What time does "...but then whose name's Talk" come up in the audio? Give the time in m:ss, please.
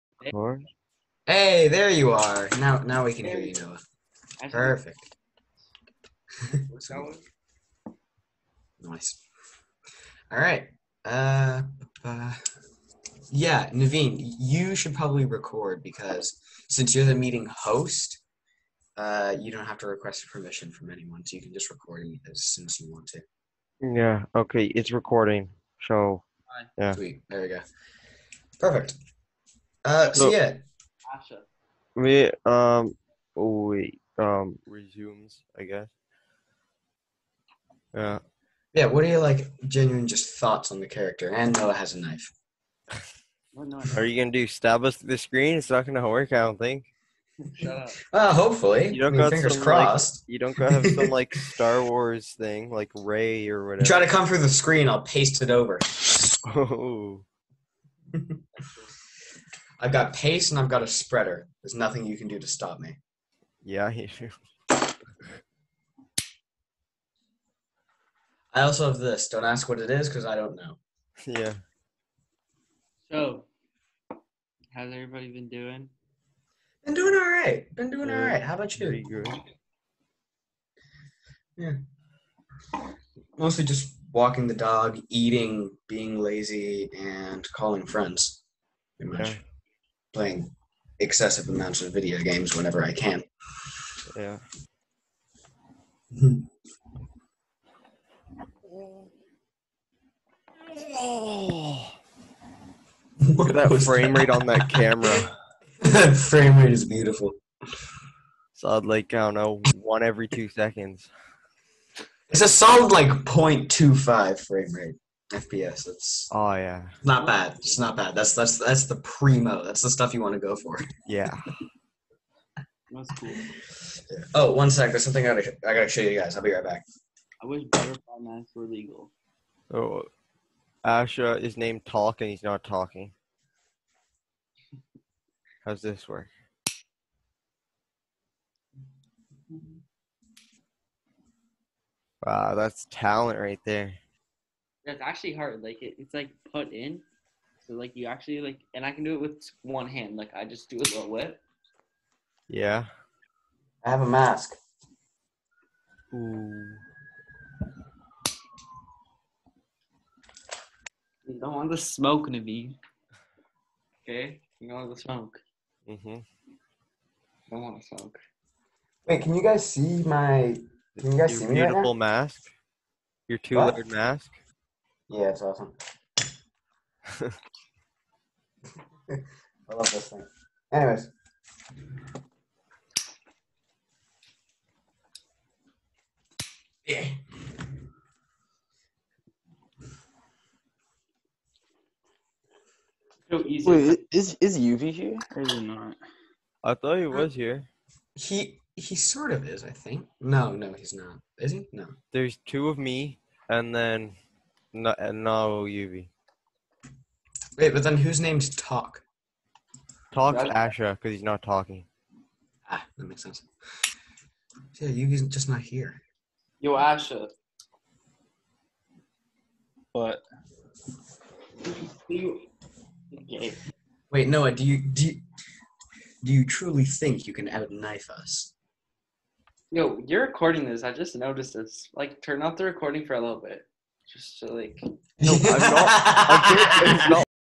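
3:27.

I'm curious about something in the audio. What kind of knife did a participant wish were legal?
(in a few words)
Butterfly knives.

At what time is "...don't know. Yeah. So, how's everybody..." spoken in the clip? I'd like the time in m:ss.
1:10.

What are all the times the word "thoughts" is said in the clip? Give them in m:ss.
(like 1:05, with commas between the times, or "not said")
0:40, 3:16.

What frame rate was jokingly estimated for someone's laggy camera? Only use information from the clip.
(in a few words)
0.25.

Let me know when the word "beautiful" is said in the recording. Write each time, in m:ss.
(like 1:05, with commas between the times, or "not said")
1:46, 2:51.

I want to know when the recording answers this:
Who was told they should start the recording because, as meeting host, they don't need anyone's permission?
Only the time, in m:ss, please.
0:13.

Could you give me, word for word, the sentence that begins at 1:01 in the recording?
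There's nothing you can do to stop me.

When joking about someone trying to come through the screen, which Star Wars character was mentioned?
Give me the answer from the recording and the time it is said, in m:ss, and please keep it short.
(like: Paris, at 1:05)
Rey, at 0:52.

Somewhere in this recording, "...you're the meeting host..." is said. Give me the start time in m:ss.
0:16.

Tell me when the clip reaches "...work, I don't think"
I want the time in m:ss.
0:46.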